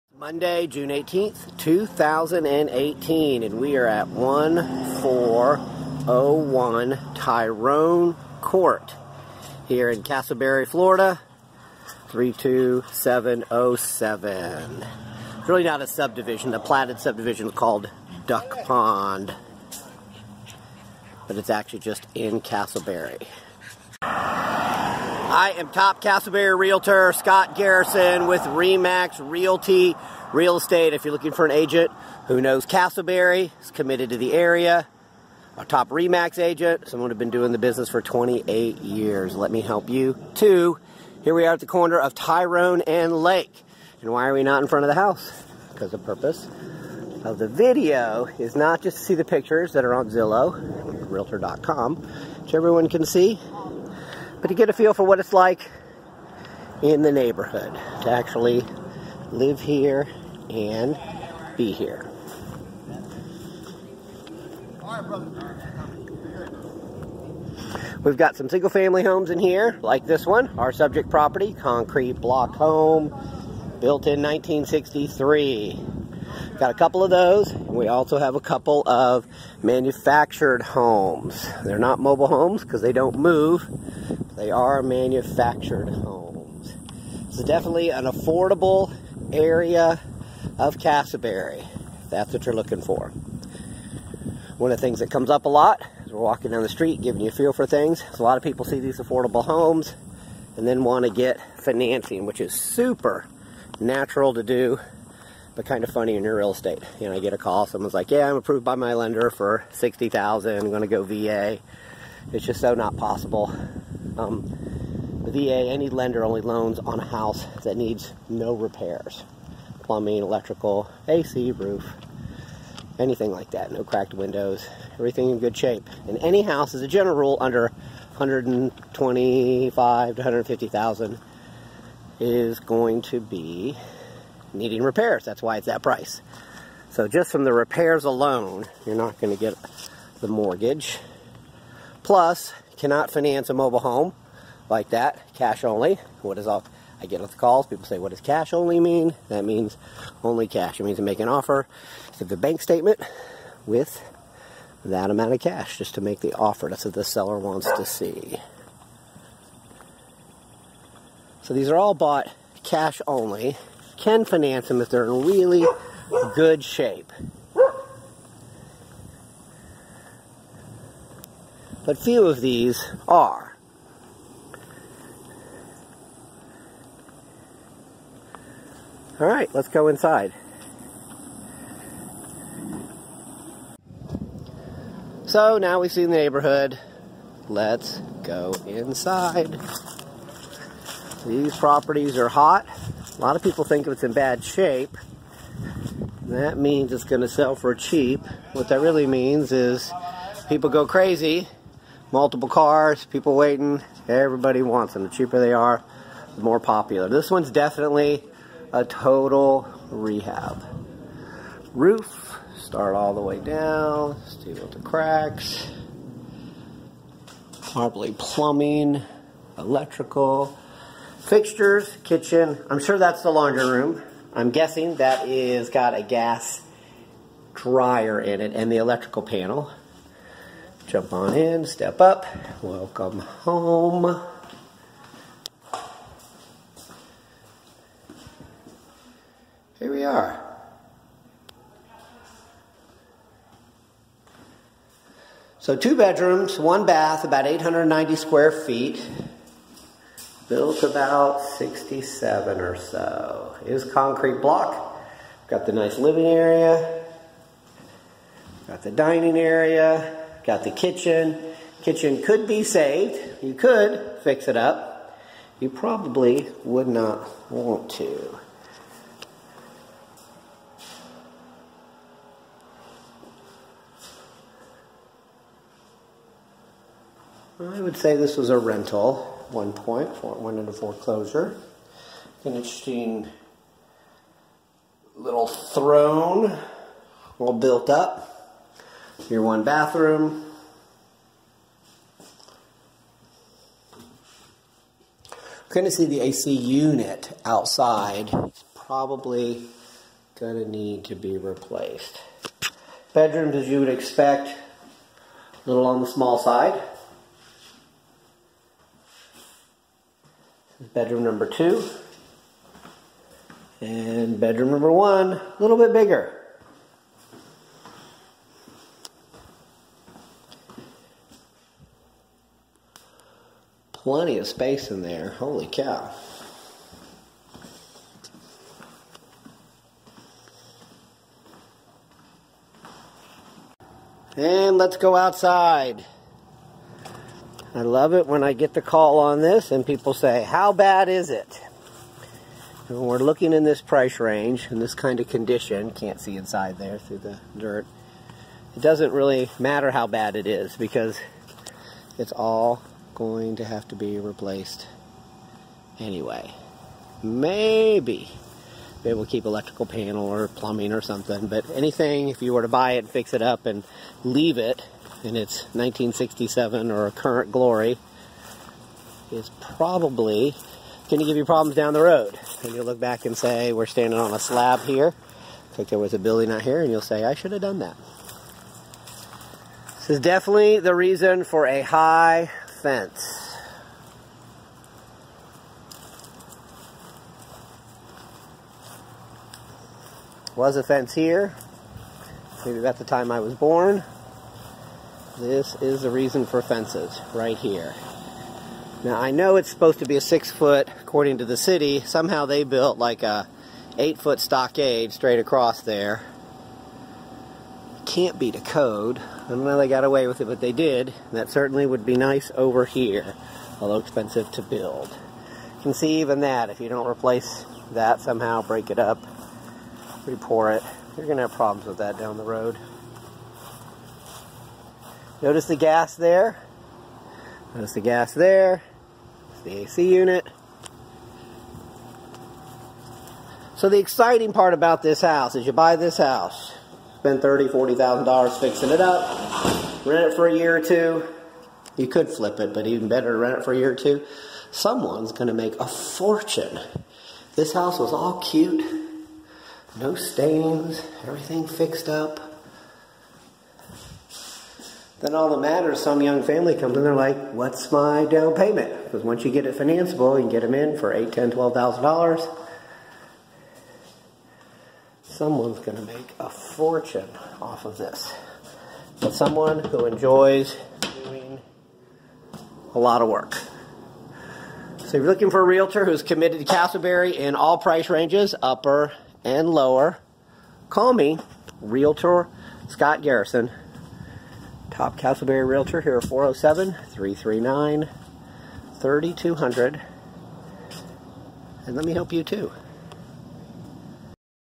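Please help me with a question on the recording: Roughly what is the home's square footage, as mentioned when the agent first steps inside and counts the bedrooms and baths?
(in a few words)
890.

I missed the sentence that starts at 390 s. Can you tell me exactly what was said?
Was a fence here, maybe about the time I was born.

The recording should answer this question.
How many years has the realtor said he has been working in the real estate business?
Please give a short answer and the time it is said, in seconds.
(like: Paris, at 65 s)
28, at 38 s.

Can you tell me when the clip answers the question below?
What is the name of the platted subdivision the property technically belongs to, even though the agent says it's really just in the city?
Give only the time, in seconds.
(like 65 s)
18 s.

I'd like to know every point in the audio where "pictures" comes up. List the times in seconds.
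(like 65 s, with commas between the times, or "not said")
49 s.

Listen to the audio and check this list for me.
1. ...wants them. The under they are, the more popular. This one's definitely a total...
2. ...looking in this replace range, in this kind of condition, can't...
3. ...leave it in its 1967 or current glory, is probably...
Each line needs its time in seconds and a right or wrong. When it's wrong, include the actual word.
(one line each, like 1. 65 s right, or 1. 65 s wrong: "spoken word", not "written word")
1. 204 s wrong: "cheaper", not "under"
2. 343 s wrong: "price", not "replace"
3. 364 s right.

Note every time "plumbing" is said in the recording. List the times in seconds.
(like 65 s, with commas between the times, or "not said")
119 s, 218 s, 360 s.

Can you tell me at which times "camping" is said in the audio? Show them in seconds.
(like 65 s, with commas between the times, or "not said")
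not said.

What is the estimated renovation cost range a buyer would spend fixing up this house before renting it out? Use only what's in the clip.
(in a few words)
$30,000 to $40,000.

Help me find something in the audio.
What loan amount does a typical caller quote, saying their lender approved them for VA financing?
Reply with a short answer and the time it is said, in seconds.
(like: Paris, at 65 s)
60000, at 109 s.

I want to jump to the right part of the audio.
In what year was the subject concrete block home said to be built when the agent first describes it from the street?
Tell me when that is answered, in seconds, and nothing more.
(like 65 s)
74 s.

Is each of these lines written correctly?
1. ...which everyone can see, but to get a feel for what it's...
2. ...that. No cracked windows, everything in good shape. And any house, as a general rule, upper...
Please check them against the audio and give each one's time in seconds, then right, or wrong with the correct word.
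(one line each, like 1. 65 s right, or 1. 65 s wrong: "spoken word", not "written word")
1. 52 s right
2. 123 s wrong: "under", not "upper".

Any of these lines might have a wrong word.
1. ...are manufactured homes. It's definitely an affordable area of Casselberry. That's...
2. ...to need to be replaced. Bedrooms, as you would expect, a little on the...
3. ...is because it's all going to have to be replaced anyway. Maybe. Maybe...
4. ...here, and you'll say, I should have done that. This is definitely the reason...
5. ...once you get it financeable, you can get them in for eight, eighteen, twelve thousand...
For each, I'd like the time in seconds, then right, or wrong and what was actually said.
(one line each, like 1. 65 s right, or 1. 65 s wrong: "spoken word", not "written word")
1. 84 s right
2. 300 s right
3. 350 s right
4. 376 s right
5. 459 s wrong: "ten", not "eighteen".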